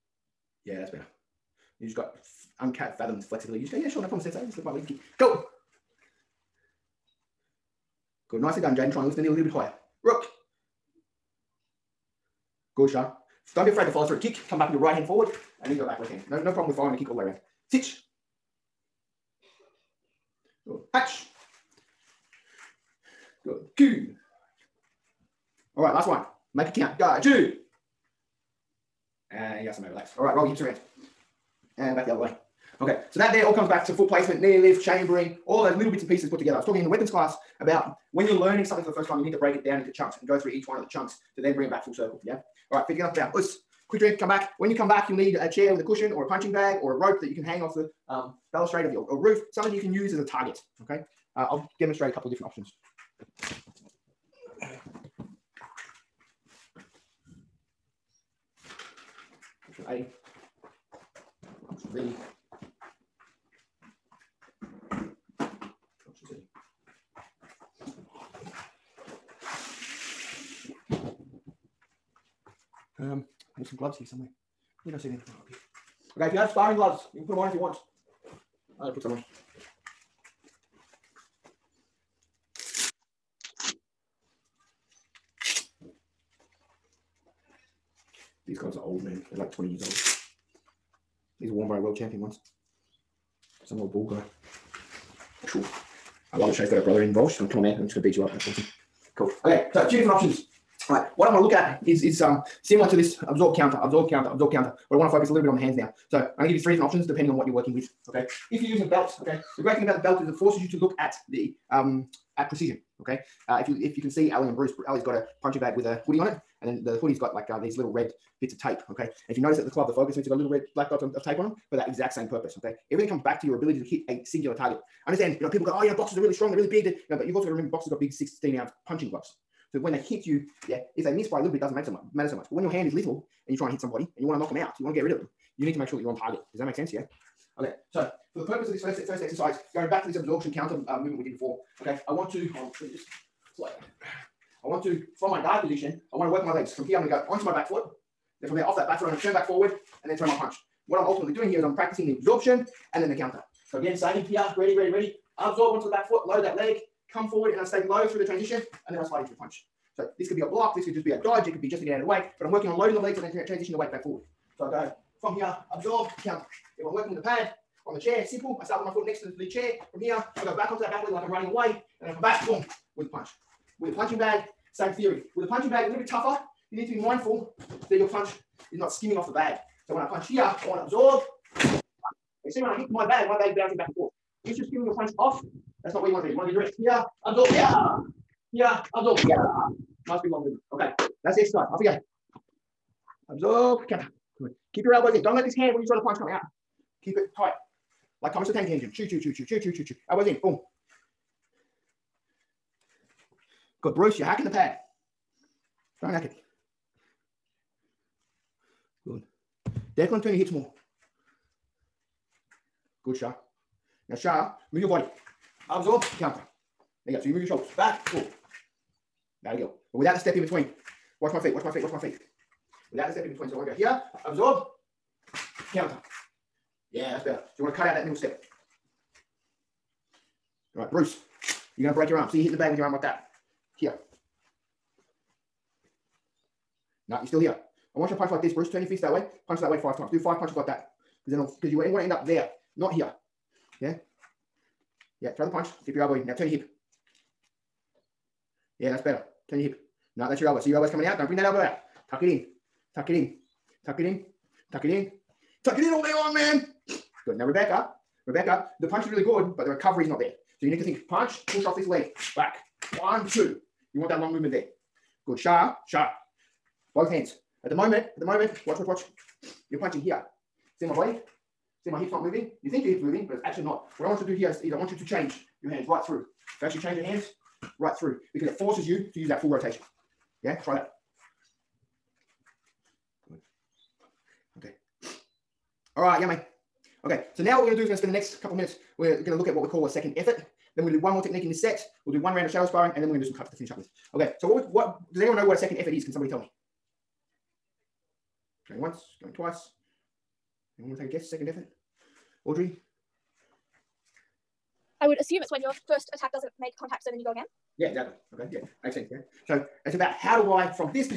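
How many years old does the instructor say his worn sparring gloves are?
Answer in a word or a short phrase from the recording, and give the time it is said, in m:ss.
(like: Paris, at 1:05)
20, at 1:29.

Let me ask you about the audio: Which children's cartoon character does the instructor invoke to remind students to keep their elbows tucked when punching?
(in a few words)
Thomas the Tank Engine.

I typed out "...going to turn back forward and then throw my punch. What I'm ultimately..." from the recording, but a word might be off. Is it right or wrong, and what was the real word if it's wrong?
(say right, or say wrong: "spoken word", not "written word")
right.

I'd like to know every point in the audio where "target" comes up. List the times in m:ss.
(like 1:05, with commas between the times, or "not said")
0:50, 2:04, 2:16.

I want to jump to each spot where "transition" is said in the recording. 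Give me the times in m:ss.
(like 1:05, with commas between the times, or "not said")
2:38, 2:43.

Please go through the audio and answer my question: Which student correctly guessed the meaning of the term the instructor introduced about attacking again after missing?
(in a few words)
Audrey.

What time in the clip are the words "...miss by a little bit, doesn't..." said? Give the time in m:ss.
2:11.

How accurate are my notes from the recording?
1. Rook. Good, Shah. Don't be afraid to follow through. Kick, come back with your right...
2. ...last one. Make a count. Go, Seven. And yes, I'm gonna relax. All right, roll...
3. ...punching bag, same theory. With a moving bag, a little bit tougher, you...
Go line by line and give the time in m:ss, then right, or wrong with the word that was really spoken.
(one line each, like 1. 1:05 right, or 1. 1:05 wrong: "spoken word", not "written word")
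1. 0:10 right
2. 0:25 wrong: "Two", not "Seven"
3. 2:53 wrong: "punching", not "moving".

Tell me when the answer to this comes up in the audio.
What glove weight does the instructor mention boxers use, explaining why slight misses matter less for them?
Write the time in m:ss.
2:08.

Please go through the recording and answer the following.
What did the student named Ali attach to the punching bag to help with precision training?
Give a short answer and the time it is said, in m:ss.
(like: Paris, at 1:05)
A hoodie, at 1:55.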